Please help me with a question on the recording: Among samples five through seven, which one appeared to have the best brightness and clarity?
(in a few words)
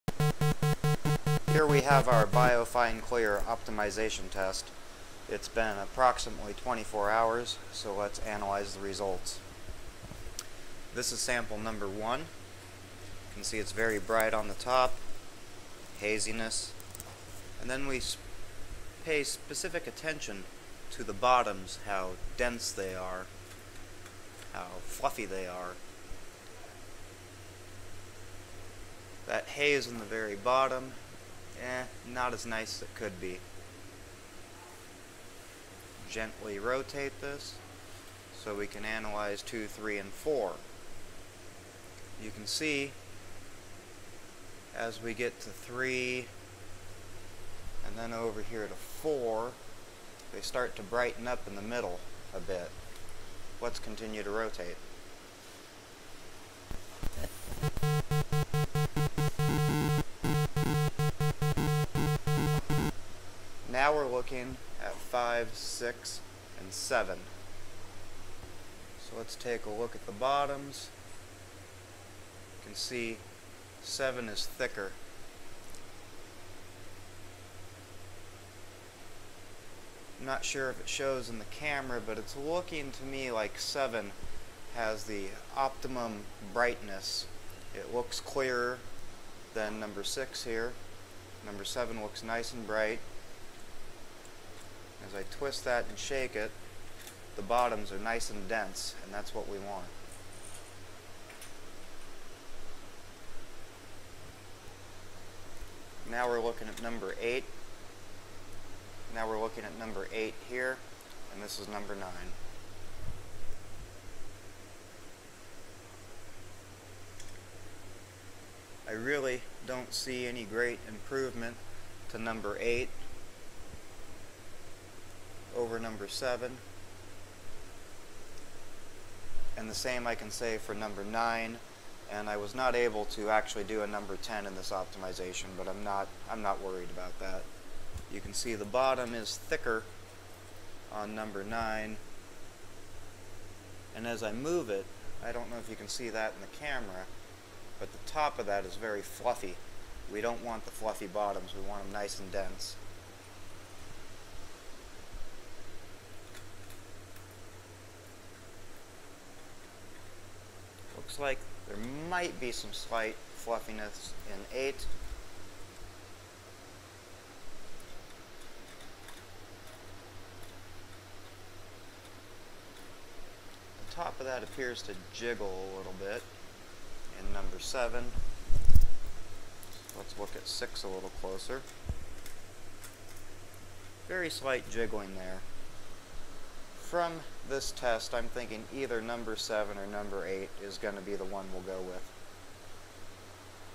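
7.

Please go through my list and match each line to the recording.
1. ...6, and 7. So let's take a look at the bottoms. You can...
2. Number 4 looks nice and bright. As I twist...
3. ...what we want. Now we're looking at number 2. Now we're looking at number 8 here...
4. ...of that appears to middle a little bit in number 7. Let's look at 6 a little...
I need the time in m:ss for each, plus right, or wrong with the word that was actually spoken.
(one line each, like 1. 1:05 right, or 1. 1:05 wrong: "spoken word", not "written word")
1. 1:05 right
2. 1:31 wrong: "7", not "4"
3. 1:39 wrong: "8", not "2"
4. 2:54 wrong: "jiggle", not "middle".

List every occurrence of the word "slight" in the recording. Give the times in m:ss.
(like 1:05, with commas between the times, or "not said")
2:42, 3:04.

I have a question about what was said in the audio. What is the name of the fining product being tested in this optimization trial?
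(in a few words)
BioFine Clear.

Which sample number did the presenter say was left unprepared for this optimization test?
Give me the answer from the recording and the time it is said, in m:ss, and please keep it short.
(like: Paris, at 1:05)
10, at 2:13.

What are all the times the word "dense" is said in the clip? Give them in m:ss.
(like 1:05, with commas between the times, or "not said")
0:22, 1:38, 2:32.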